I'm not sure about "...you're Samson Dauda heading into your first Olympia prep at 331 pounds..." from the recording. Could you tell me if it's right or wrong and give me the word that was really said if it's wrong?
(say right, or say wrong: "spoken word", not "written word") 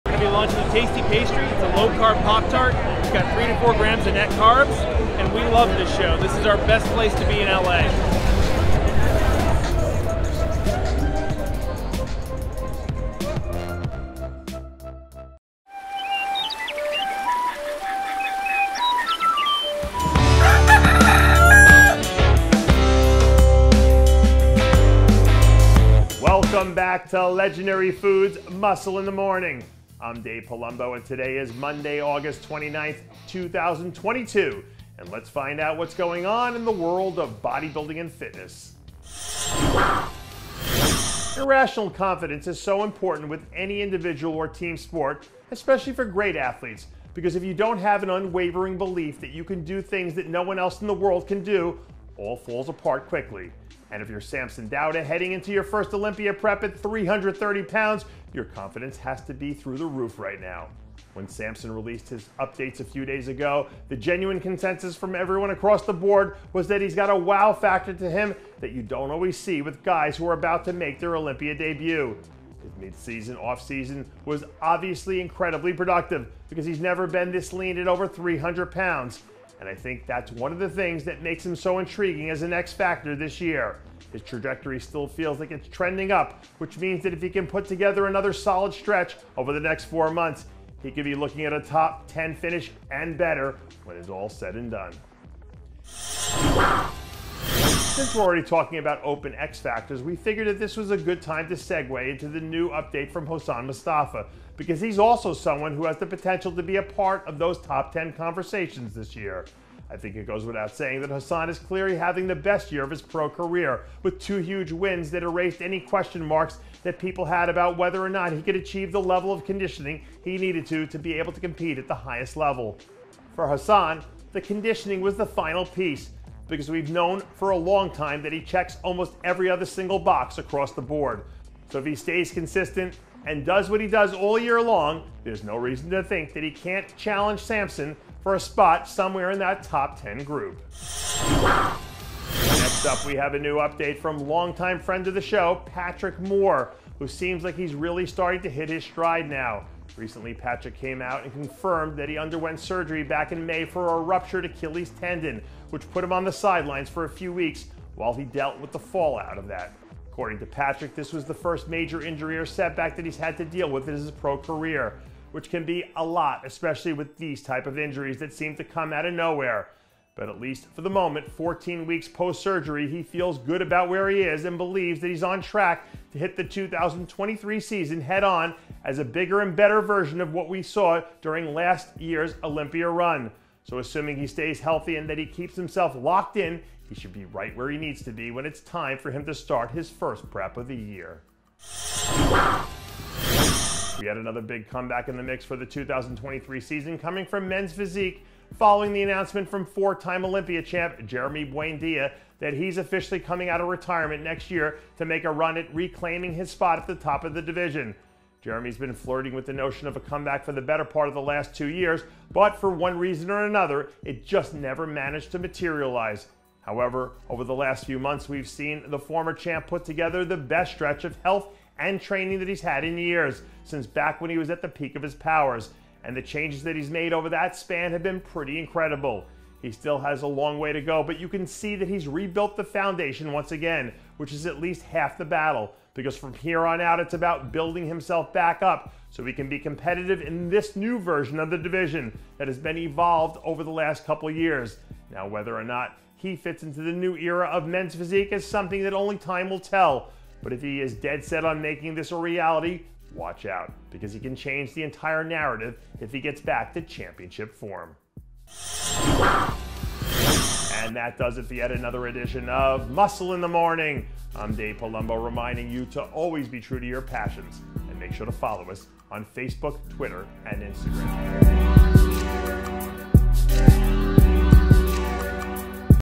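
wrong: "330", not "331".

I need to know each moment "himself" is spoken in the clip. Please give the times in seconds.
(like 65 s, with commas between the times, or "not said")
185 s, 237 s.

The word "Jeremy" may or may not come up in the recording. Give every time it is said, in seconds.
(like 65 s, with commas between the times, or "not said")
201 s, 208 s.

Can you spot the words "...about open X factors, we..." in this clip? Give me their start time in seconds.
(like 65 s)
98 s.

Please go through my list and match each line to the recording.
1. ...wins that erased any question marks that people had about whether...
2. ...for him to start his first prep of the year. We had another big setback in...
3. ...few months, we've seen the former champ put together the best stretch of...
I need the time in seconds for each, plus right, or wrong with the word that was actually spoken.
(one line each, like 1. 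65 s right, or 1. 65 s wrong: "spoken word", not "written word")
1. 114 s right
2. 188 s wrong: "comeback", not "setback"
3. 217 s right.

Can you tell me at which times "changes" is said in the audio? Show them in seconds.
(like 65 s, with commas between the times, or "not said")
226 s, 254 s.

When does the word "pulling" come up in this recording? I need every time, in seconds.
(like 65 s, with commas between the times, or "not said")
not said.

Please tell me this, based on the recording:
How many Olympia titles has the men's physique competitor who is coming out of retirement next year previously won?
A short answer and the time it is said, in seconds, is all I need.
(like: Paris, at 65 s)
4, at 199 s.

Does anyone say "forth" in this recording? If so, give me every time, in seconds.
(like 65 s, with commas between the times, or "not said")
not said.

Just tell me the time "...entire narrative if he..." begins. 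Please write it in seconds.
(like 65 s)
254 s.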